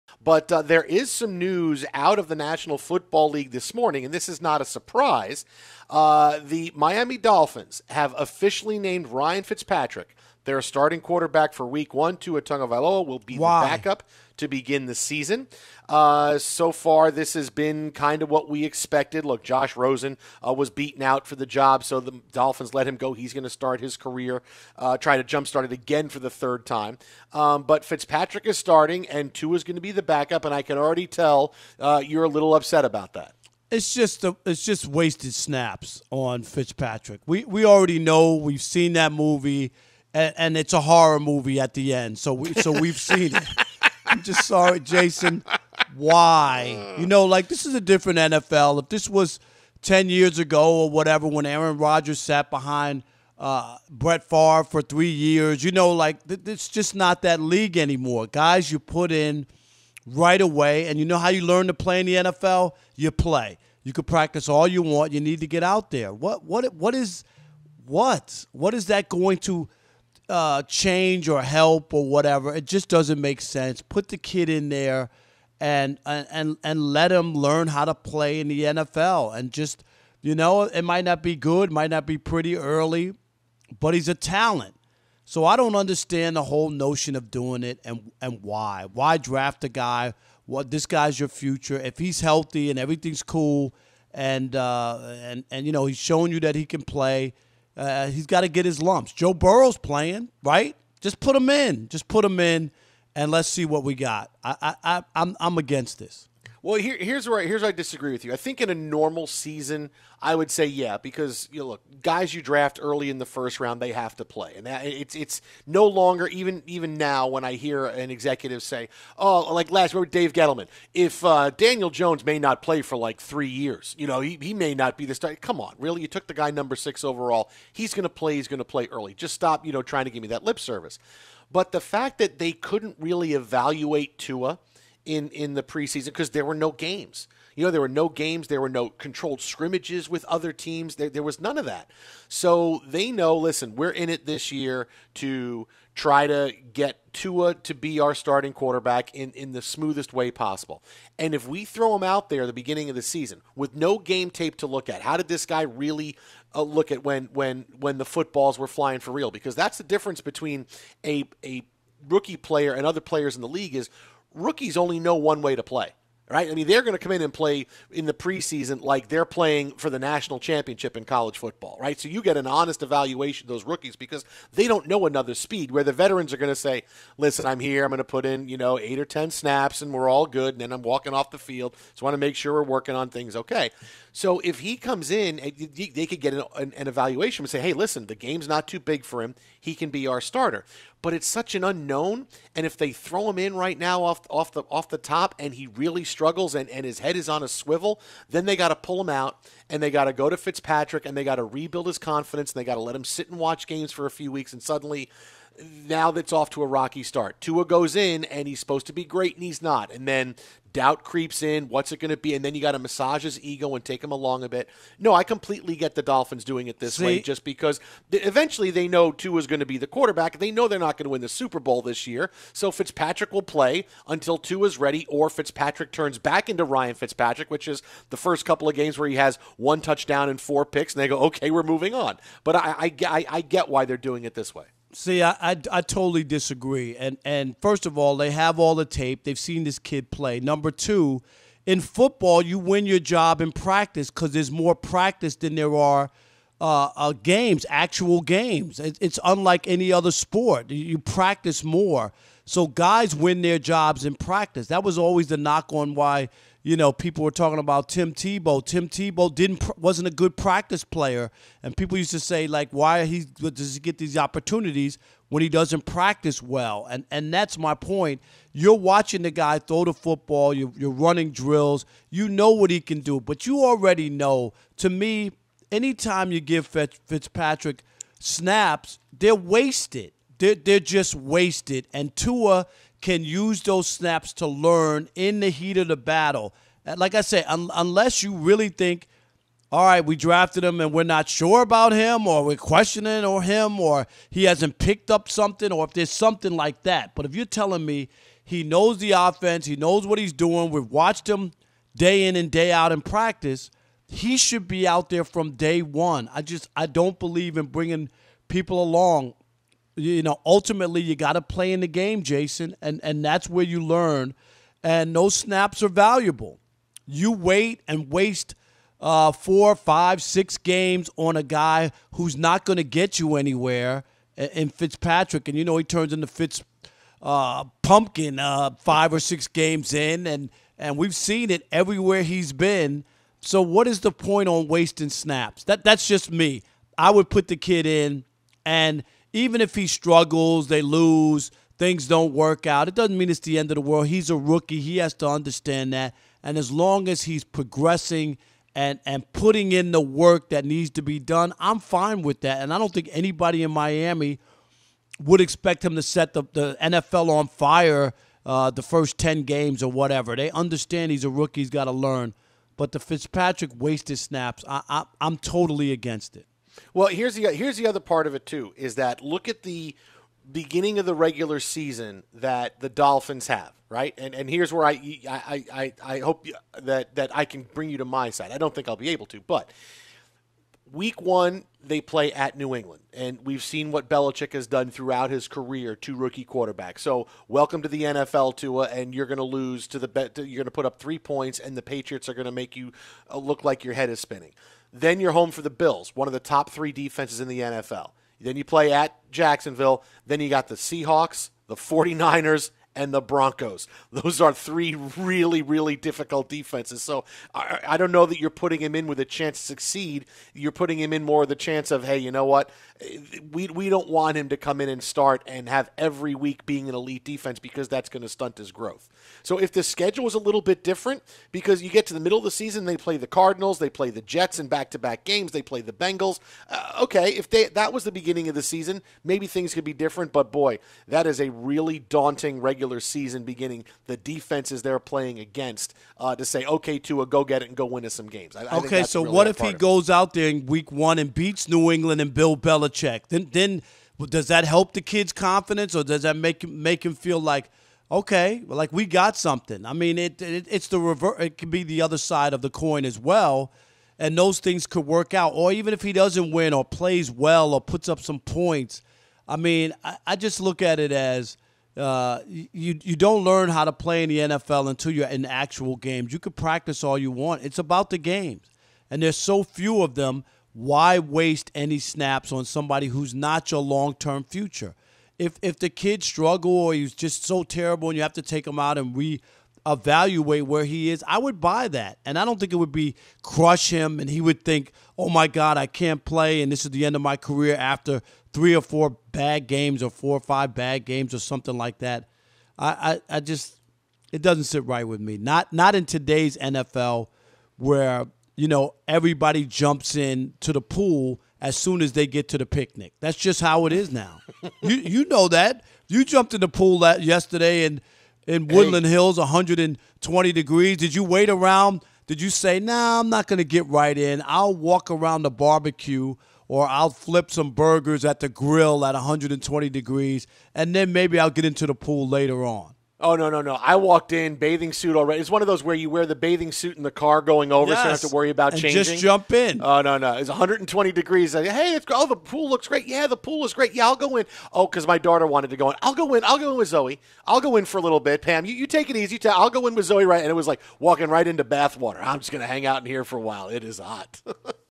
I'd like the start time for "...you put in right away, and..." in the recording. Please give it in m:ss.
0:58.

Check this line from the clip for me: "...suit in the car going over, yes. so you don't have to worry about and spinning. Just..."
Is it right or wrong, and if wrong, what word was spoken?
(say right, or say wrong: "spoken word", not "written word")
wrong: "changing", not "spinning".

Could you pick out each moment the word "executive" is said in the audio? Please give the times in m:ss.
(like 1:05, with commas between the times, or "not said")
1:58.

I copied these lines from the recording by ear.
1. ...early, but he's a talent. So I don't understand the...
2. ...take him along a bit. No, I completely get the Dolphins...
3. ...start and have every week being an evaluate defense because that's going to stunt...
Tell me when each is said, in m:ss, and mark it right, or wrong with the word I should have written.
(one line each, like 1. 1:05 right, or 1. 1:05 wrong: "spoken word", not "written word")
1. 1:22 right
2. 3:33 right
3. 6:55 wrong: "elite", not "evaluate".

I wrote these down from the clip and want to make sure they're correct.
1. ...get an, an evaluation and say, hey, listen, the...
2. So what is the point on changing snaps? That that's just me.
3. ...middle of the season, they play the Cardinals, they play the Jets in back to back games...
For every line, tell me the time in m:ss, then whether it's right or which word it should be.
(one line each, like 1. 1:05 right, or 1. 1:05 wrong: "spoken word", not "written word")
1. 3:06 right
2. 5:33 wrong: "wasting", not "changing"
3. 7:02 right.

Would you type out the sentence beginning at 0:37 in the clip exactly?
We we already know we've seen that movie and, and it's a horror movie at the end.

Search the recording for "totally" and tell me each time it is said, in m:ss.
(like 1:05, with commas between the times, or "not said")
3:55, 6:05.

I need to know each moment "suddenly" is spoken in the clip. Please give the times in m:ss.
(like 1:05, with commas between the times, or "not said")
3:24.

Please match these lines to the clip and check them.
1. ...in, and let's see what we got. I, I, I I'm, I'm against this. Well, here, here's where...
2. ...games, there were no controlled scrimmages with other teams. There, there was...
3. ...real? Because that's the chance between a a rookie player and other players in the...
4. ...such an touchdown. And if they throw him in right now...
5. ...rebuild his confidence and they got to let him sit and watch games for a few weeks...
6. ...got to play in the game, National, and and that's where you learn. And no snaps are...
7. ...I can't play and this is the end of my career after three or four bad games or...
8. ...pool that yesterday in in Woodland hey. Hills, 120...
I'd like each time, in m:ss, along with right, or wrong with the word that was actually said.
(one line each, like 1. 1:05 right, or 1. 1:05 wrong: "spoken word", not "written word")
1. 1:42 right
2. 2:18 right
3. 2:39 wrong: "difference", not "chance"
4. 3:11 wrong: "unknown", not "touchdown"
5. 3:21 right
6. 5:11 wrong: "Jason", not "National"
7. 8:05 right
8. 8:26 right.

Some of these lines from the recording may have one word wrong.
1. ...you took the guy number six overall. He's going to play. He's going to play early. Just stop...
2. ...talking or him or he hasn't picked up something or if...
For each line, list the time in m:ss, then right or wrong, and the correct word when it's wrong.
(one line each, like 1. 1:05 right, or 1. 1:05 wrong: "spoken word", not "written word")
1. 2:06 right
2. 4:52 wrong: "questioning", not "talking".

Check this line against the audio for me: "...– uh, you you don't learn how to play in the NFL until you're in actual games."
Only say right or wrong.
right.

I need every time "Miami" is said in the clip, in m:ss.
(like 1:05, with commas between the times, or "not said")
0:06, 5:53.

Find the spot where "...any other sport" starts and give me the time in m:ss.
4:09.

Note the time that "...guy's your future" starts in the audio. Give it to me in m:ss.
1:30.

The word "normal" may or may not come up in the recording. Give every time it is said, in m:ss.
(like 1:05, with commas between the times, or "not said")
1:48.